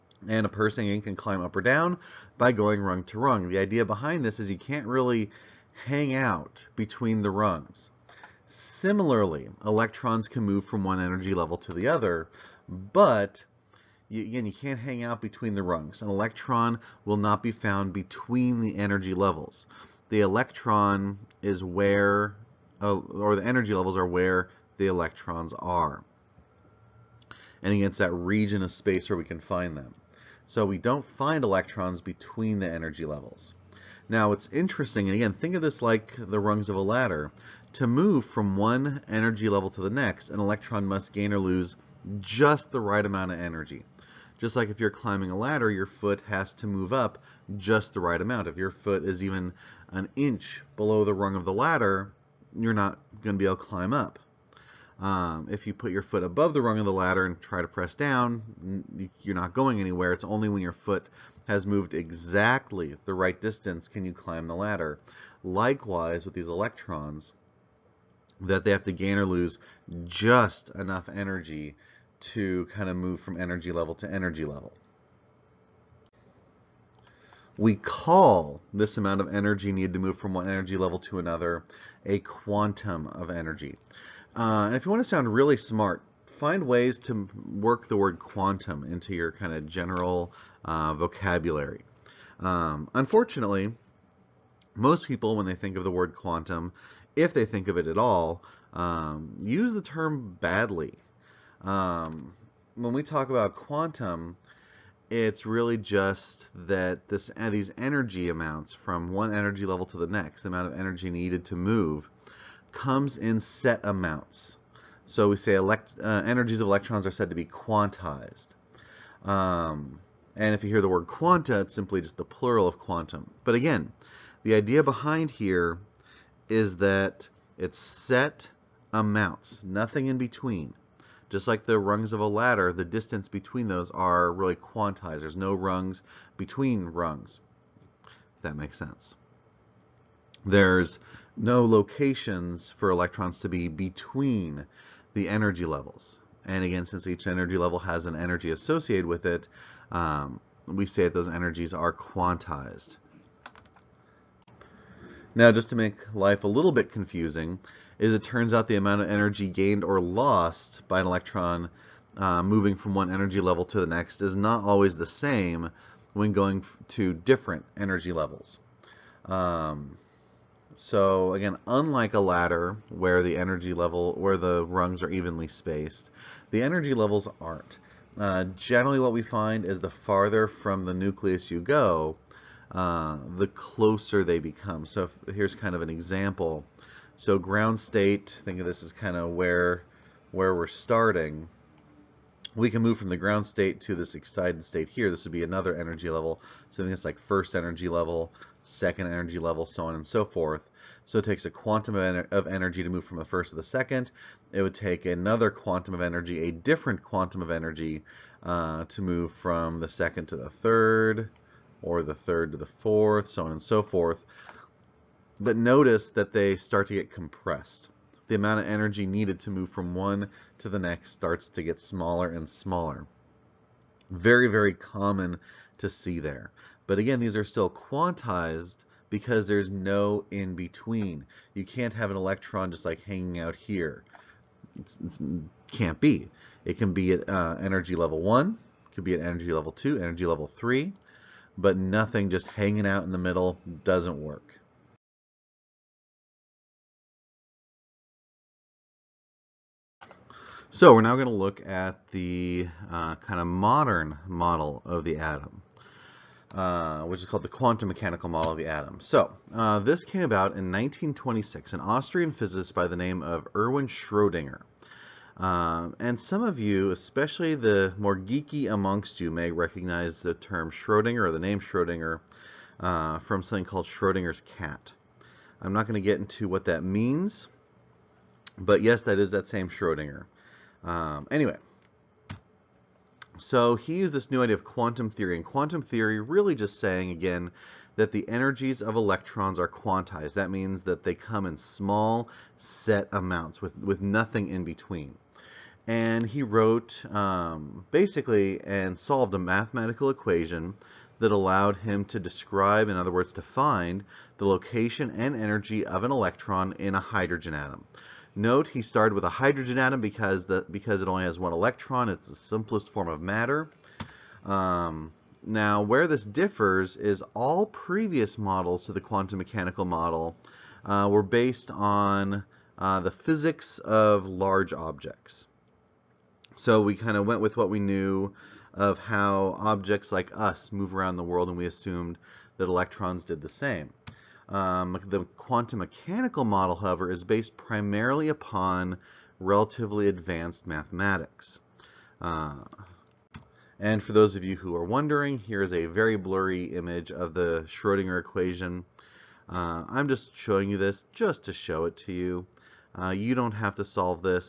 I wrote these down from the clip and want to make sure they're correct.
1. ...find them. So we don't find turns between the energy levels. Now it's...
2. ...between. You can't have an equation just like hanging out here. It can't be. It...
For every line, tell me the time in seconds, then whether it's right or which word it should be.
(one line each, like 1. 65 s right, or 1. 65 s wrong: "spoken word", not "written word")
1. 29 s wrong: "electrons", not "turns"
2. 230 s wrong: "electron", not "equation".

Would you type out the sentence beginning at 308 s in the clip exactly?
Note he started with a hydrogen atom because the because it only has one electron.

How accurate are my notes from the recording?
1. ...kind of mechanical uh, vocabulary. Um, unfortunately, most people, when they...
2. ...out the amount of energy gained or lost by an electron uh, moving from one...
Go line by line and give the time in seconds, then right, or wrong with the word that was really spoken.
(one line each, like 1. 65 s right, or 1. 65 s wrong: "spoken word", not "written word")
1. 89 s wrong: "general", not "mechanical"
2. 158 s right.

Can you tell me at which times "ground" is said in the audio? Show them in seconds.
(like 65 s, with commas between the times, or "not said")
187 s, 193 s.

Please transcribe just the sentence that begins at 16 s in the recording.
An electron will not be found between the energy levels.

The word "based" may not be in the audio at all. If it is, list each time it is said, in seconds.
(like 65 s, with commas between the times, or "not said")
321 s, 337 s.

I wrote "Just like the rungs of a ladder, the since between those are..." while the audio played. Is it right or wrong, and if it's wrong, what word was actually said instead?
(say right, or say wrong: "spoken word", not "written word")
wrong: "distance", not "since".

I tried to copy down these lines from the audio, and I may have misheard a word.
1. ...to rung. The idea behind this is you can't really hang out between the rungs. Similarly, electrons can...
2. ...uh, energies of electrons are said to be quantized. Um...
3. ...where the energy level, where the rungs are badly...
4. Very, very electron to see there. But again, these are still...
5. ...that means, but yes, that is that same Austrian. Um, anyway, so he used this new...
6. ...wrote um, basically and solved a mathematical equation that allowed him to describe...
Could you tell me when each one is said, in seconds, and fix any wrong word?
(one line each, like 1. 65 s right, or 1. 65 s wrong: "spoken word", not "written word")
1. 3 s right
2. 116 s right
3. 172 s wrong: "evenly", not "badly"
4. 224 s wrong: "common", not "electron"
5. 276 s wrong: "Schrodinger", not "Austrian"
6. 296 s right.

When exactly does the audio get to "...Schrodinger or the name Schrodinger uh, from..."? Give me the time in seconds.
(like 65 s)
270 s.